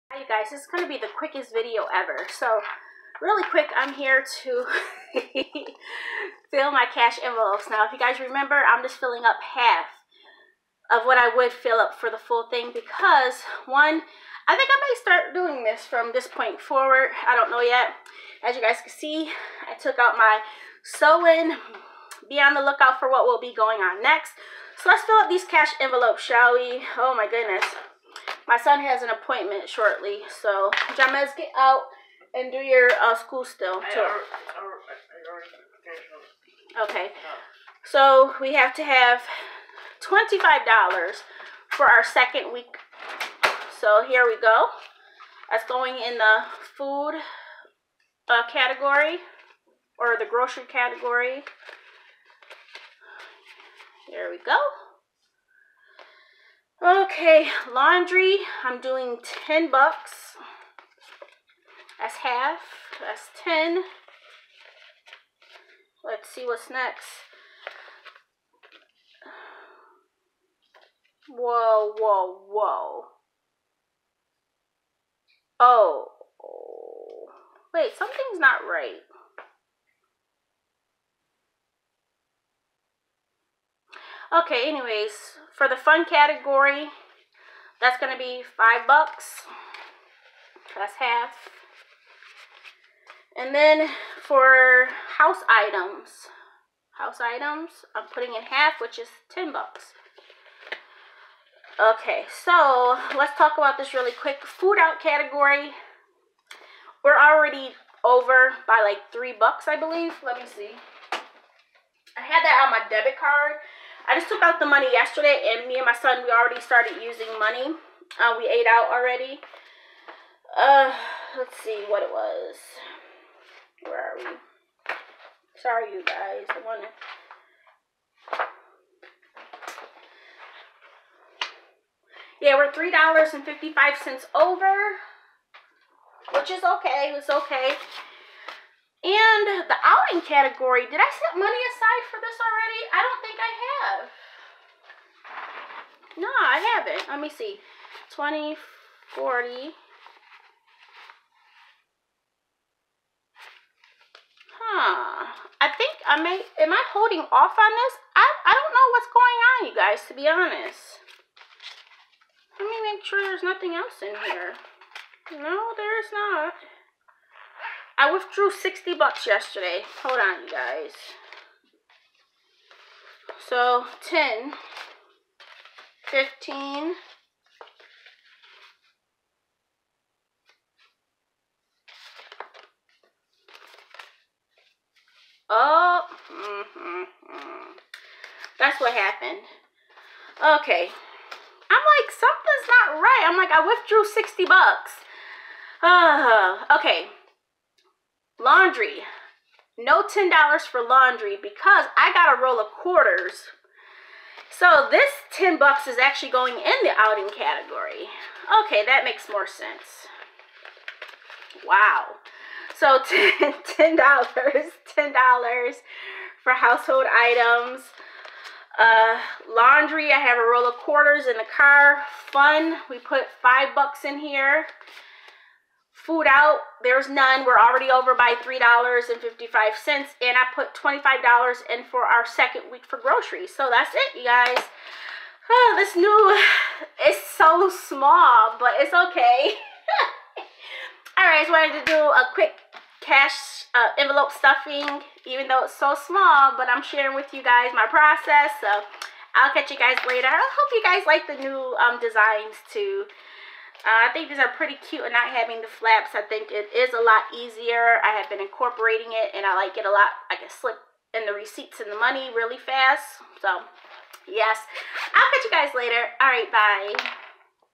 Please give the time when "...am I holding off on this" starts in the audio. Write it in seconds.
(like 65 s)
156 s.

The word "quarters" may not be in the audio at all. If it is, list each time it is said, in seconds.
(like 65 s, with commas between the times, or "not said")
202 s, 220 s.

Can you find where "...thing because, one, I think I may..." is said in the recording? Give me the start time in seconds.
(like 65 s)
12 s.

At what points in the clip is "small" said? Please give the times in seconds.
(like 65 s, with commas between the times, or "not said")
237 s, 245 s.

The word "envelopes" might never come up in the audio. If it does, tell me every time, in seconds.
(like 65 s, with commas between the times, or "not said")
7 s, 25 s, 243 s.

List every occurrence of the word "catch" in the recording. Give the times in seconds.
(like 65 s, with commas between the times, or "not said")
249 s, 265 s.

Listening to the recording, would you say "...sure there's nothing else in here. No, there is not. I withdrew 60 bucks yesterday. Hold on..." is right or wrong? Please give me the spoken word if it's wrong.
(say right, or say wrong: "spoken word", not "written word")
right.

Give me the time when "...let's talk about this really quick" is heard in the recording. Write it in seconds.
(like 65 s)
103 s.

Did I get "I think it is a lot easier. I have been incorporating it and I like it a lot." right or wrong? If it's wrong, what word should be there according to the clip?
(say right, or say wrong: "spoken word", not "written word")
right.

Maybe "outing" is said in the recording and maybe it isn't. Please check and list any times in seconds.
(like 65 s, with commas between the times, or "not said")
139 s, 206 s.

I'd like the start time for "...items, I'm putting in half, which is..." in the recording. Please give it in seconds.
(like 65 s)
97 s.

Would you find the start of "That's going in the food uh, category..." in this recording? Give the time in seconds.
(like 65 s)
45 s.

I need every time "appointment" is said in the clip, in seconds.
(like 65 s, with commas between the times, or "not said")
29 s.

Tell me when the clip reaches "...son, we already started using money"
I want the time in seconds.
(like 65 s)
115 s.